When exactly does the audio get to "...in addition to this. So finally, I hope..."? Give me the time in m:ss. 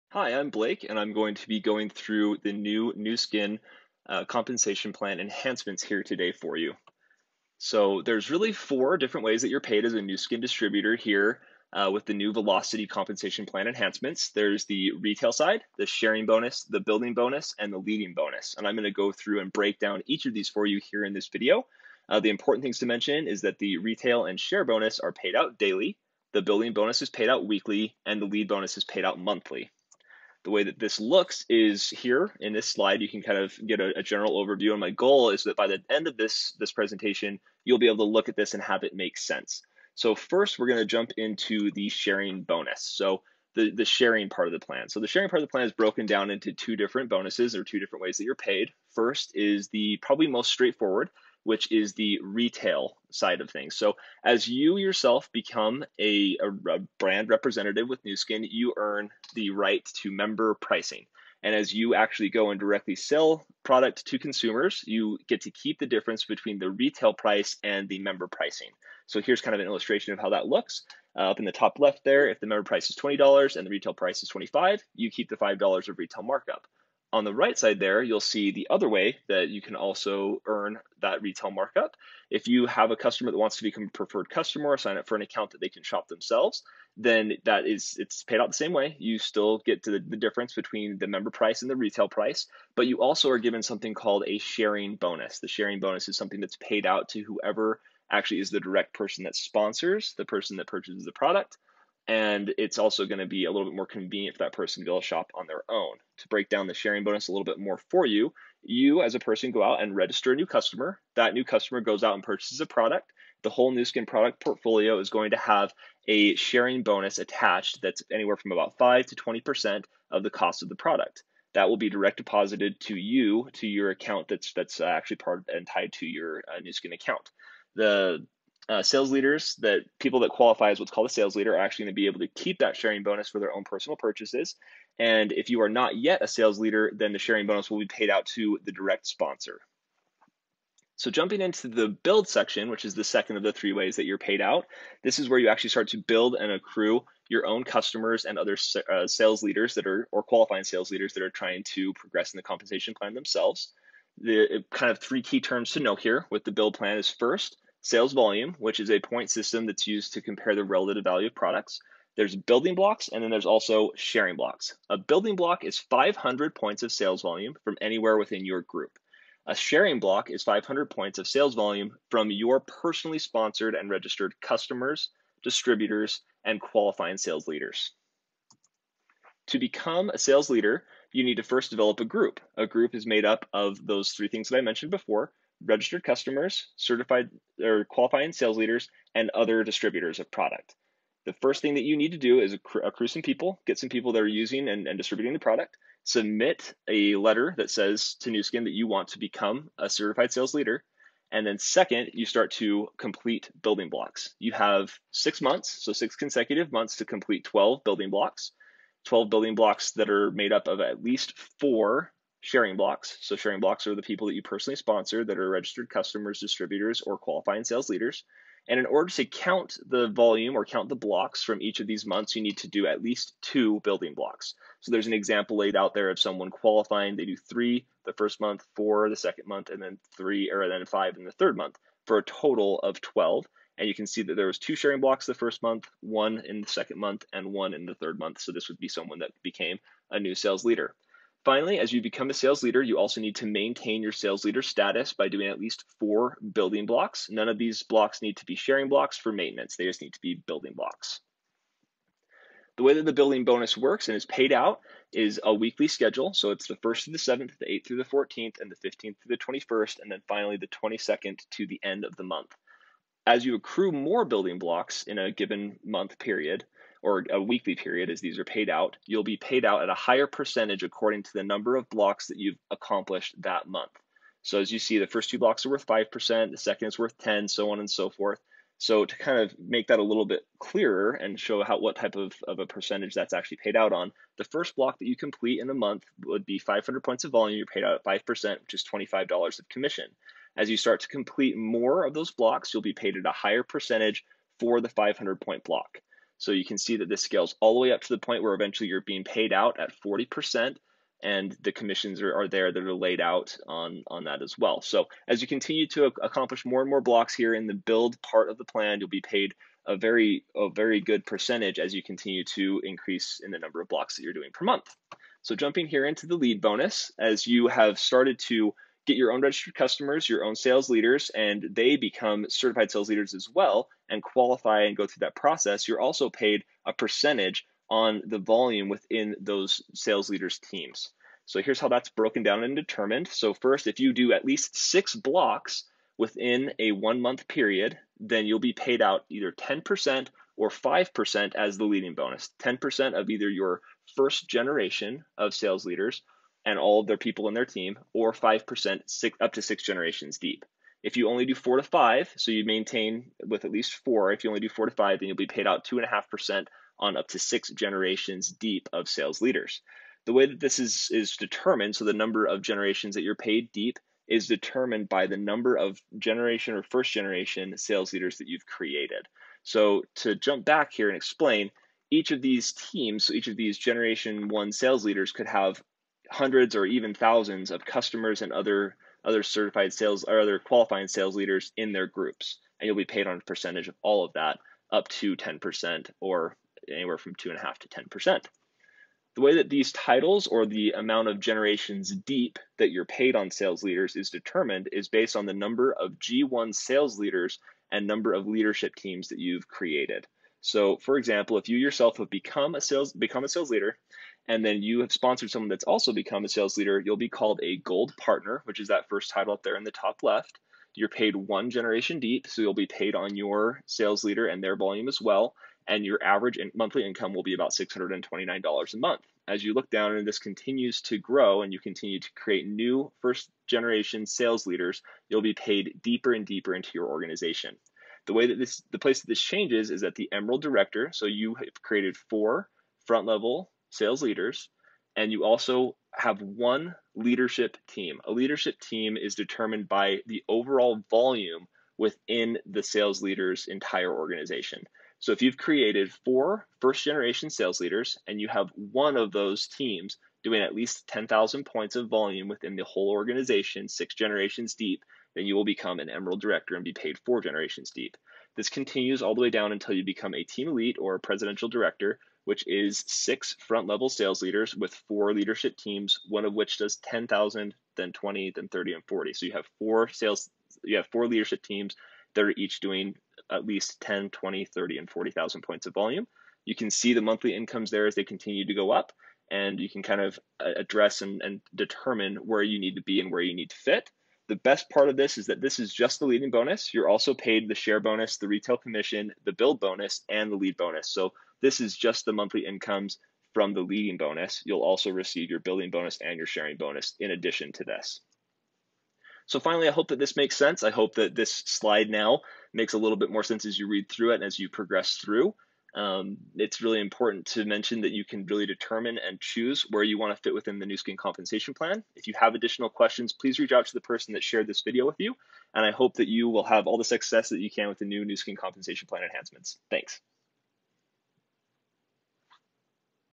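8:17.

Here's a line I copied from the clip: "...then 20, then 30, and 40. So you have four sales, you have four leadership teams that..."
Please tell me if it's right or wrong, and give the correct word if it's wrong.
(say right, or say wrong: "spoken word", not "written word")
right.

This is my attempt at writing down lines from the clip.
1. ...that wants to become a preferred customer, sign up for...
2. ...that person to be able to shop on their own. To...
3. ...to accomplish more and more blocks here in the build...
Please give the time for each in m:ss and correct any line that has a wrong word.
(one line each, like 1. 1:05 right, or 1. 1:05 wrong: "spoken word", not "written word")
1. 1:23 right
2. 1:44 right
3. 5:05 right.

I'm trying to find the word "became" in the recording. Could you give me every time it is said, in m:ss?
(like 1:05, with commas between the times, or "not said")
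3:59.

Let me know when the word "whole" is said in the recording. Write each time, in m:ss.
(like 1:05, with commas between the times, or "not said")
1:53, 7:32.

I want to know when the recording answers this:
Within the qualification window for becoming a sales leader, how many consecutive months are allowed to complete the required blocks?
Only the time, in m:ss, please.
3:25.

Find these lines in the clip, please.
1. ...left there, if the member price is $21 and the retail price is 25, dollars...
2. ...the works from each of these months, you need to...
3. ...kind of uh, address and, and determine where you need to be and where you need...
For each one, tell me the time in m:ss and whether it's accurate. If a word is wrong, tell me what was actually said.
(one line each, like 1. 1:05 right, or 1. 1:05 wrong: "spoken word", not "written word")
1. 1:11 wrong: "20", not "21"
2. 3:40 wrong: "blocks", not "works"
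3. 8:00 right.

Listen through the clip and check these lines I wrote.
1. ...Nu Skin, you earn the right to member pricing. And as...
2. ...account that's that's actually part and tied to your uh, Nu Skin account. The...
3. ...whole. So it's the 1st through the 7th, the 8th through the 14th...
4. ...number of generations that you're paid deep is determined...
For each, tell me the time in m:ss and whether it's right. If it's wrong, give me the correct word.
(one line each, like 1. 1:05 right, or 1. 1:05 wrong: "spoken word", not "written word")
1. 0:58 right
2. 2:03 right
3. 4:15 wrong: "schedule", not "whole"
4. 6:02 right.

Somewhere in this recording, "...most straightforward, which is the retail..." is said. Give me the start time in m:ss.
0:50.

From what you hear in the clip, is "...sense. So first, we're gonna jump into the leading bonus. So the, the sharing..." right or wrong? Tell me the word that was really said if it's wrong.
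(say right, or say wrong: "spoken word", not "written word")
wrong: "sharing", not "leading".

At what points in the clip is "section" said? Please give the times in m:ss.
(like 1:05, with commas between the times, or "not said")
2:22.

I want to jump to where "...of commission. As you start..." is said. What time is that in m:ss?
4:49.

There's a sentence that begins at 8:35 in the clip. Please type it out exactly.
And I hope that you will have all the success that you can with the new Nu Skin compensation plan enhancements.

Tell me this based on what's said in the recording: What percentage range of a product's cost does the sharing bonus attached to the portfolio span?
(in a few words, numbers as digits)
5 to 20%.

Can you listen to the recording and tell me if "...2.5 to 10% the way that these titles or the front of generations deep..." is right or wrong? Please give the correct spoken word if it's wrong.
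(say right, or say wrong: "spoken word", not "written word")
wrong: "amount", not "front".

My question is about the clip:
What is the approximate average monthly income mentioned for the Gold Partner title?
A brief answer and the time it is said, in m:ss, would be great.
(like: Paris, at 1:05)
$629, at 6:57.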